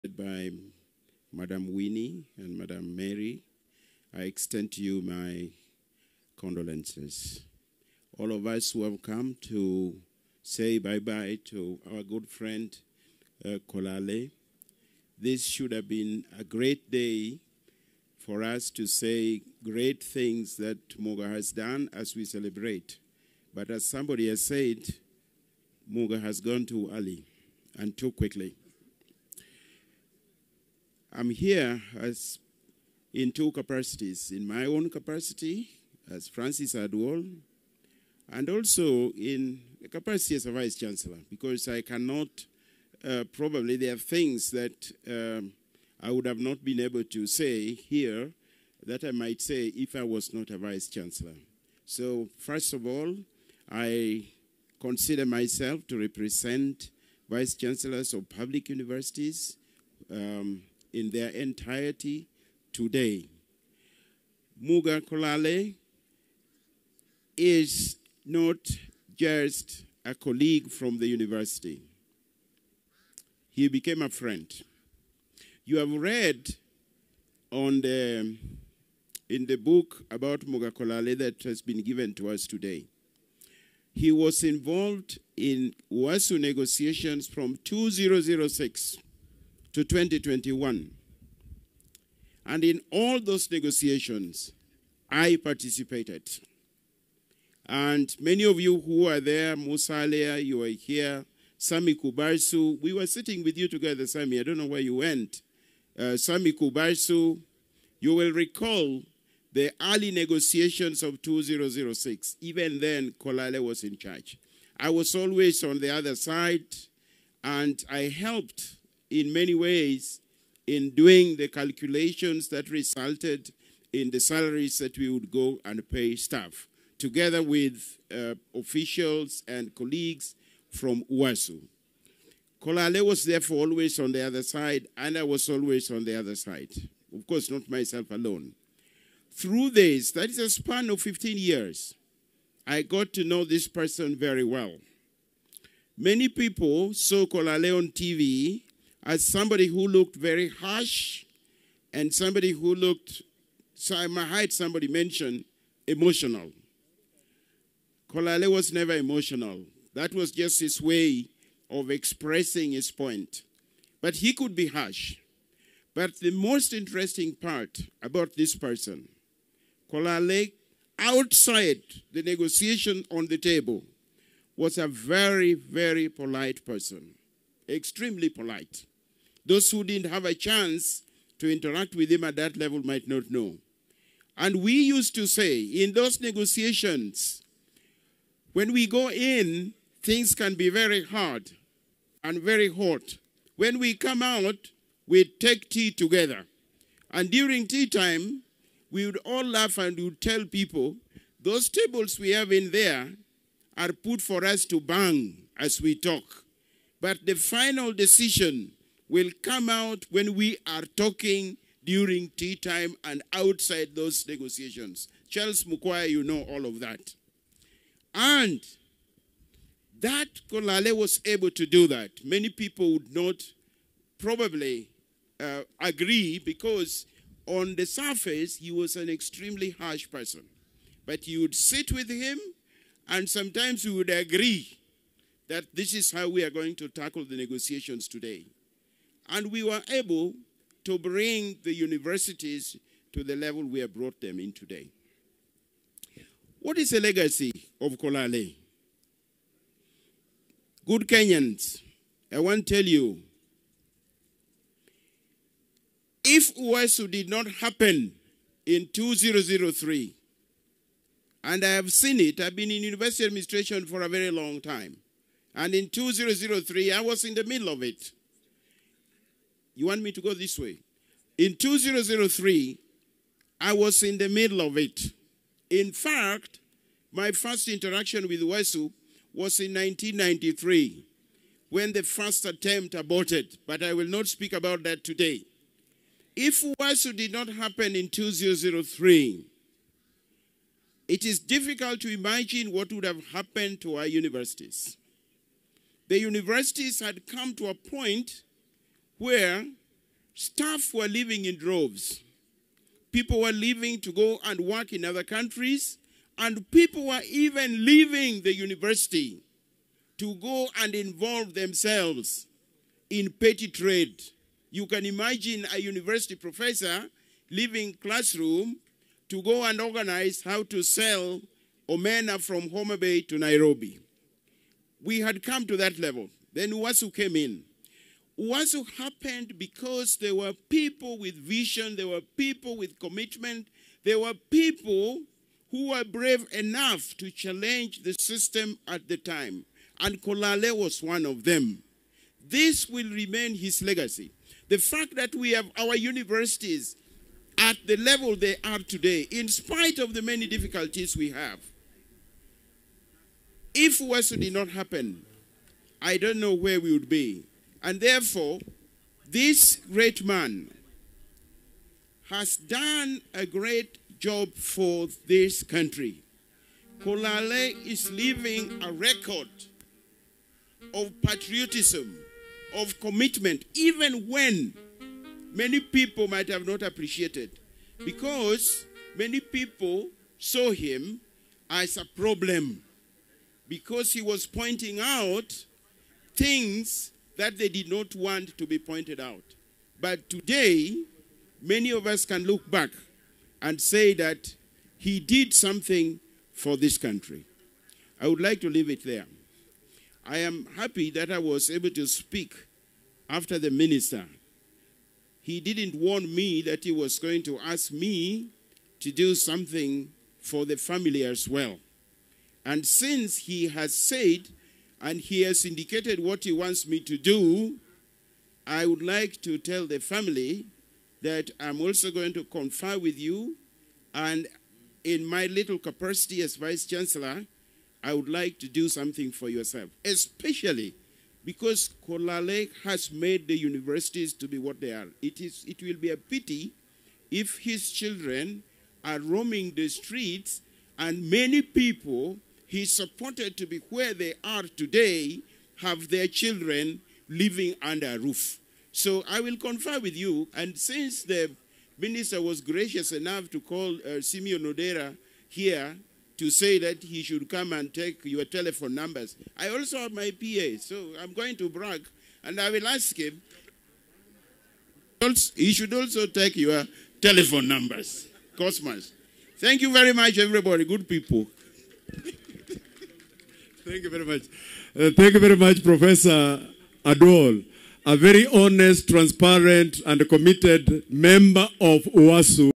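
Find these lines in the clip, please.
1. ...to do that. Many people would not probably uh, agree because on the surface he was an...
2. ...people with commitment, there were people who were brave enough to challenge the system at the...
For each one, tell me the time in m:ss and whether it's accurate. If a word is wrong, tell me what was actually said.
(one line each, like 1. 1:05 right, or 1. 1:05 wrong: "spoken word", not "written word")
1. 3:41 right
2. 5:32 right.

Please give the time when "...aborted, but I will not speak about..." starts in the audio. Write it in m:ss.
4:42.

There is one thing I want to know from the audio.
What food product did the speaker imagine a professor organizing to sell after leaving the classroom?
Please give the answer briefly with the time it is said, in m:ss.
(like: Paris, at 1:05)
omena, at 5:21.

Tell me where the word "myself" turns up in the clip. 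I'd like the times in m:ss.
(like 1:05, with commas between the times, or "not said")
0:55, 2:17.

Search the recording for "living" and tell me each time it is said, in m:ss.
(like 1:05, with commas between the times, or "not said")
7:27.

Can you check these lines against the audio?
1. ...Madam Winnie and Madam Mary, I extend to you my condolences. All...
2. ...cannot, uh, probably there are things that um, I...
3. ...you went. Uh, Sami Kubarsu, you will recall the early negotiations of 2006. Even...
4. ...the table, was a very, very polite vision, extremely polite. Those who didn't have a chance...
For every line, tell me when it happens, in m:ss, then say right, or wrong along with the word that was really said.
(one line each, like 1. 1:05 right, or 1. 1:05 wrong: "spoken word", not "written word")
1. 0:01 right
2. 0:41 right
3. 1:44 right
4. 2:53 wrong: "person", not "vision".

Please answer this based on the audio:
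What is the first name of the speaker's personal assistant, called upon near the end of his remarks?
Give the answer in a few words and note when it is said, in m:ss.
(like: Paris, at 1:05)
Cosmas, at 7:48.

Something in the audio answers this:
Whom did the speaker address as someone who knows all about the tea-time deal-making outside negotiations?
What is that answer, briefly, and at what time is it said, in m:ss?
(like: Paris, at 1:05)
Charles Mukwai, at 3:35.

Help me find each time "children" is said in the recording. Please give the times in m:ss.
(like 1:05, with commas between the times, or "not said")
7:17, 7:26.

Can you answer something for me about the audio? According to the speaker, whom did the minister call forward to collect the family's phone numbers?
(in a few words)
Simeon Odera.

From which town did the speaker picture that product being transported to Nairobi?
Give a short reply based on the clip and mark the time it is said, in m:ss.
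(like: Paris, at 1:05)
Homa Bay, at 5:22.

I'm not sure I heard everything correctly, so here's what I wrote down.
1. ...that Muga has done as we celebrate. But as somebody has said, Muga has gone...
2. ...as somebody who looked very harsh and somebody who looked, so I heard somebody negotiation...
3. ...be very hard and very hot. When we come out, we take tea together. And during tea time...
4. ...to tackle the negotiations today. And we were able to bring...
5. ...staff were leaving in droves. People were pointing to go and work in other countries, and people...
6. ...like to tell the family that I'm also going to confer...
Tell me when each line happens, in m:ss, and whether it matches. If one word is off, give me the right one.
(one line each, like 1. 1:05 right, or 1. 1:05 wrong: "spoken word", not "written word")
1. 0:20 right
2. 2:29 wrong: "mention", not "negotiation"
3. 3:10 right
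4. 3:56 right
5. 5:00 wrong: "leaving", not "pointing"
6. 6:59 right.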